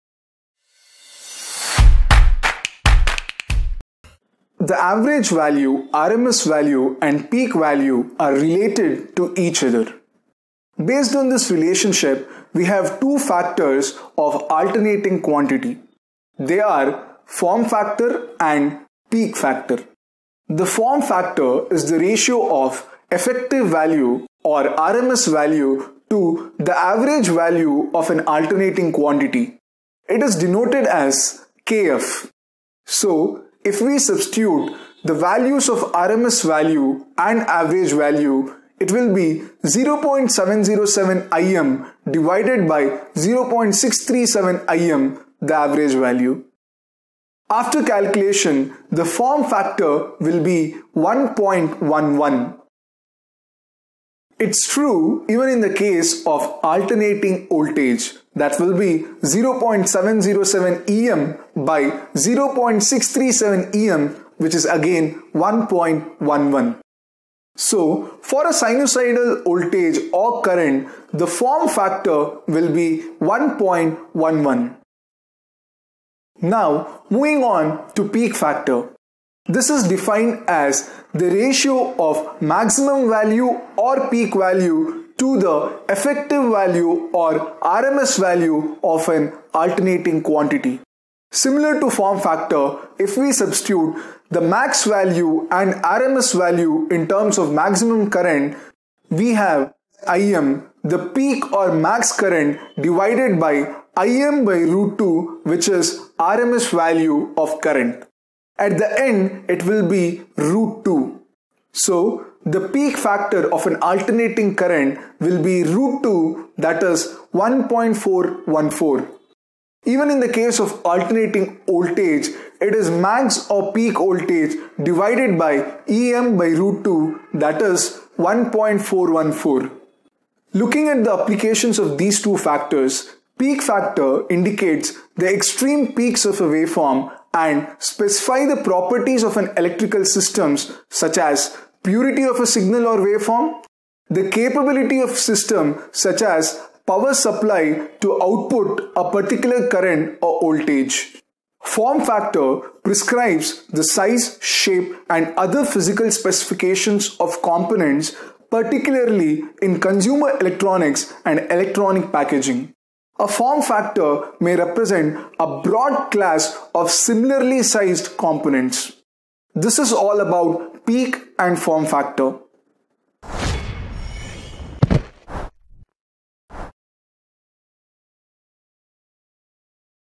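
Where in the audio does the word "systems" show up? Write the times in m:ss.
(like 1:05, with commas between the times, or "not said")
2:20, 2:25.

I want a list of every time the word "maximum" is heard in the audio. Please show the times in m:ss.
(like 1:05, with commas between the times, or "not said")
1:22, 1:37.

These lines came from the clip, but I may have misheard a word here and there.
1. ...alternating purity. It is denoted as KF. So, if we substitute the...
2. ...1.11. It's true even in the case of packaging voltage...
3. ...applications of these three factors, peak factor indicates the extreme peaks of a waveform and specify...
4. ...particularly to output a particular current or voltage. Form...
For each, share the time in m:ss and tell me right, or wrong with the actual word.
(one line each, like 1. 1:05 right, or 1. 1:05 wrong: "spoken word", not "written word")
1. 0:28 wrong: "quantity", not "purity"
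2. 0:50 wrong: "alternating", not "packaging"
3. 2:11 wrong: "two", not "three"
4. 2:27 wrong: "supply", not "particularly".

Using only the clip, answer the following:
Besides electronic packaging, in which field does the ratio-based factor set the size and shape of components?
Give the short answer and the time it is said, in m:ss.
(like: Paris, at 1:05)
consumer electronics, at 2:39.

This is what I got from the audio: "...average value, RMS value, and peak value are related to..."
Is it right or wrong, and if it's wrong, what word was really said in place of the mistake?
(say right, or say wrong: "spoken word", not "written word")
right.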